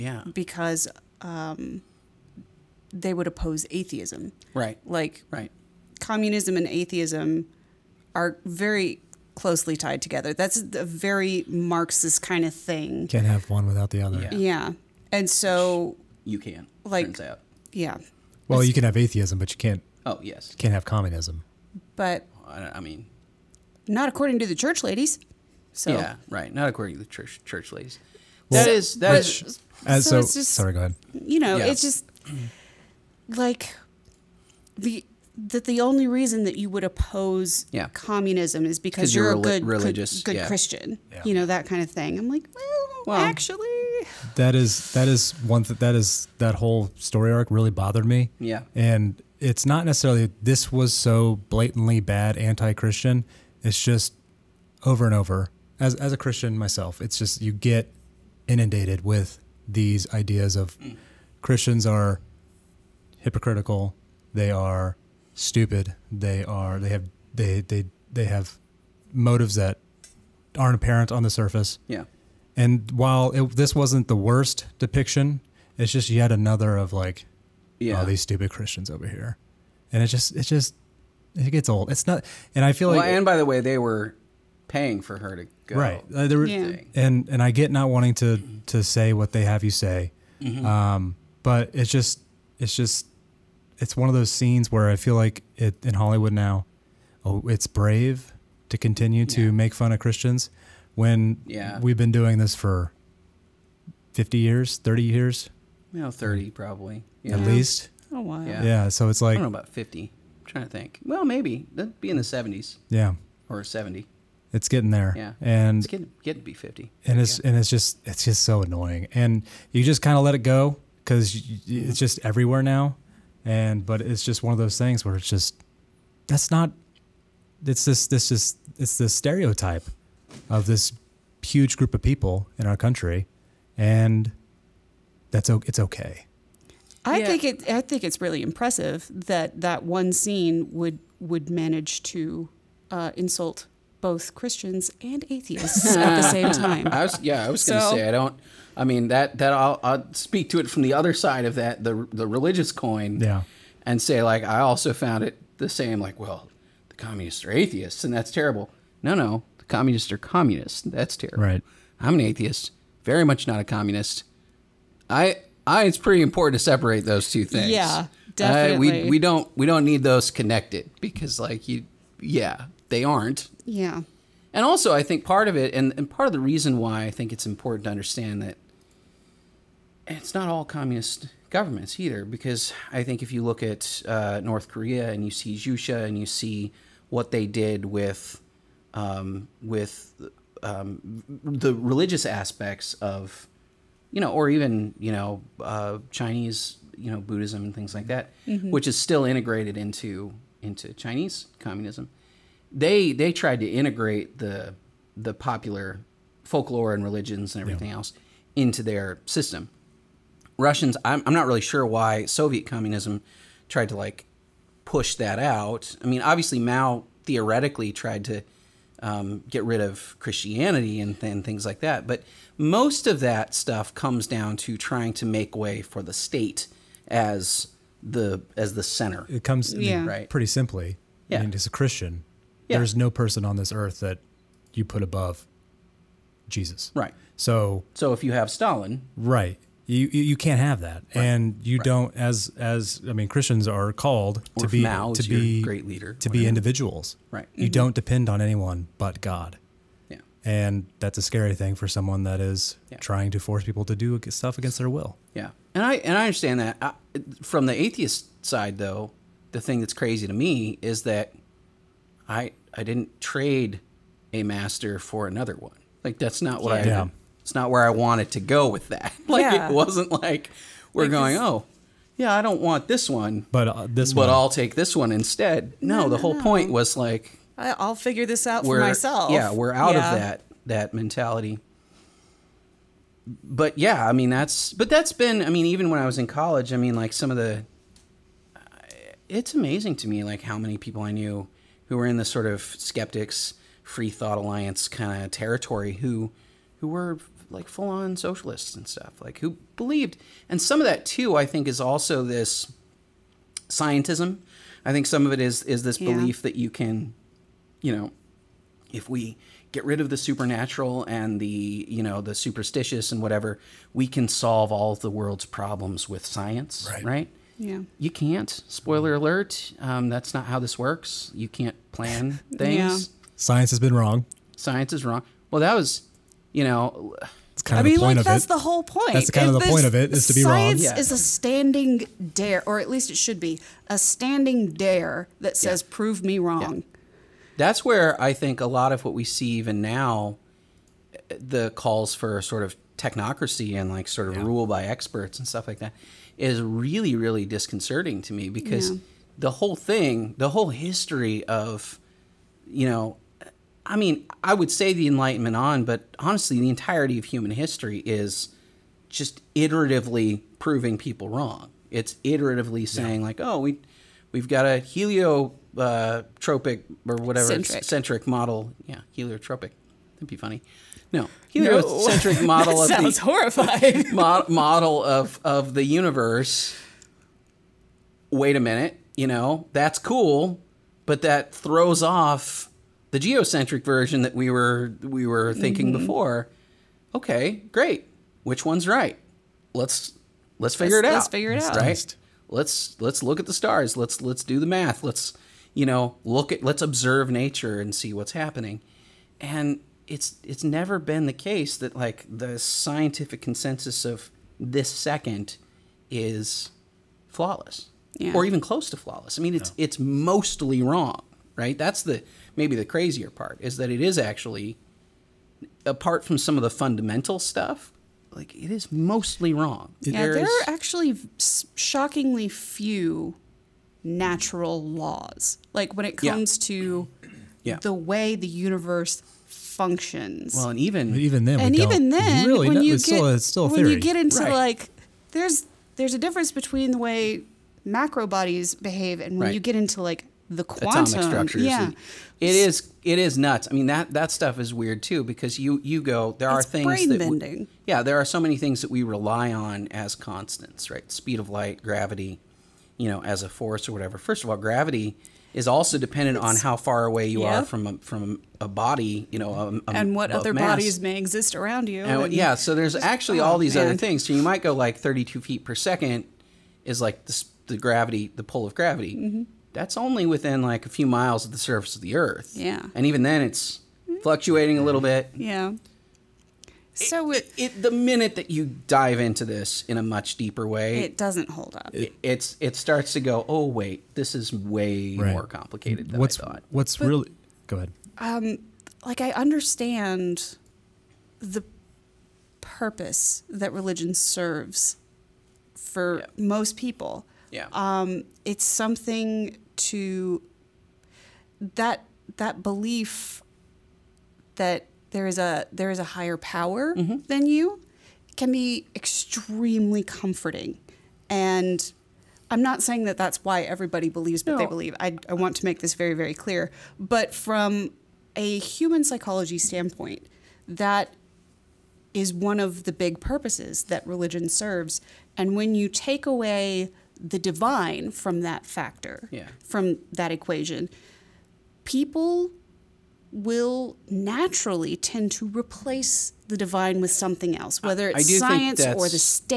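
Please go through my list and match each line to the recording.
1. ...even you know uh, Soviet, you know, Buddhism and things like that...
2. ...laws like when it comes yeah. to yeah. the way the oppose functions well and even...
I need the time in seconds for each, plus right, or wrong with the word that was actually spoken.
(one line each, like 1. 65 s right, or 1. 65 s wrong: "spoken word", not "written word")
1. 194 s wrong: "Chinese", not "Soviet"
2. 424 s wrong: "universe", not "oppose".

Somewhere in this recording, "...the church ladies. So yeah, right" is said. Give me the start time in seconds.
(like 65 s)
24 s.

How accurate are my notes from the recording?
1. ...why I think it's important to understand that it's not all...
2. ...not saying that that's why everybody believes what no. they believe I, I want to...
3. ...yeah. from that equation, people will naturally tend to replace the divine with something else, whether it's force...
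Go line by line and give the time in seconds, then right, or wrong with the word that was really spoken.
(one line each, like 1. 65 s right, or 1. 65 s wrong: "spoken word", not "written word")
1. 176 s right
2. 512 s right
3. 529 s wrong: "science", not "force".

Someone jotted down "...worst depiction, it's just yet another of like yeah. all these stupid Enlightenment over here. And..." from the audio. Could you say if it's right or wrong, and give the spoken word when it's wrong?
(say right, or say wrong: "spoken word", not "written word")
wrong: "Christians", not "Enlightenment".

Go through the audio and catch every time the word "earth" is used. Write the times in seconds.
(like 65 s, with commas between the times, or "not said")
233 s, 472 s.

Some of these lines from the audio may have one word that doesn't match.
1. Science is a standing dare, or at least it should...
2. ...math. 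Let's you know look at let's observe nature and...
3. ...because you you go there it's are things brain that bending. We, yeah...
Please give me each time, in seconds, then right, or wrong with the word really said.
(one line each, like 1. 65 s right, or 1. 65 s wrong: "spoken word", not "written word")
1. 330 s right
2. 394 s right
3. 445 s right.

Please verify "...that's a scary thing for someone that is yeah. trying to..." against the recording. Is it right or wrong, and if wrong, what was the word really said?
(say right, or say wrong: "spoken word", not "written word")
right.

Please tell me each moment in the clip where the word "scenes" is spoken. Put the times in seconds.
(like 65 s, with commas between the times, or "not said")
94 s, 140 s.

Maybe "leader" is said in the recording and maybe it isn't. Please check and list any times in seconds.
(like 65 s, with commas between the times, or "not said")
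245 s.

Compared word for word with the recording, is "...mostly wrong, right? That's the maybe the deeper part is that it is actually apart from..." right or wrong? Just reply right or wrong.
wrong.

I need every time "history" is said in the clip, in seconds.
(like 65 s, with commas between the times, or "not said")
350 s, 357 s.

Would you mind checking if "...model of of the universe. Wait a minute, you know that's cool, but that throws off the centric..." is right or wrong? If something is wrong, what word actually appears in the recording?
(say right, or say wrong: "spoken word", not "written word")
wrong: "geocentric", not "centric".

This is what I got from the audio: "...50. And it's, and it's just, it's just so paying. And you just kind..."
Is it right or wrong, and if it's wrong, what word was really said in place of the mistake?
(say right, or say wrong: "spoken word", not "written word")
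wrong: "annoying", not "paying".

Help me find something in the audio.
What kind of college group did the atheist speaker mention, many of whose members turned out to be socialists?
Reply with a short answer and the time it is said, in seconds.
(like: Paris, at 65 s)
skeptics free thought alliance, at 292 s.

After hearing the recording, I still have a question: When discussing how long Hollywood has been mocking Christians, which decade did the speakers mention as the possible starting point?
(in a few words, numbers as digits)
70s.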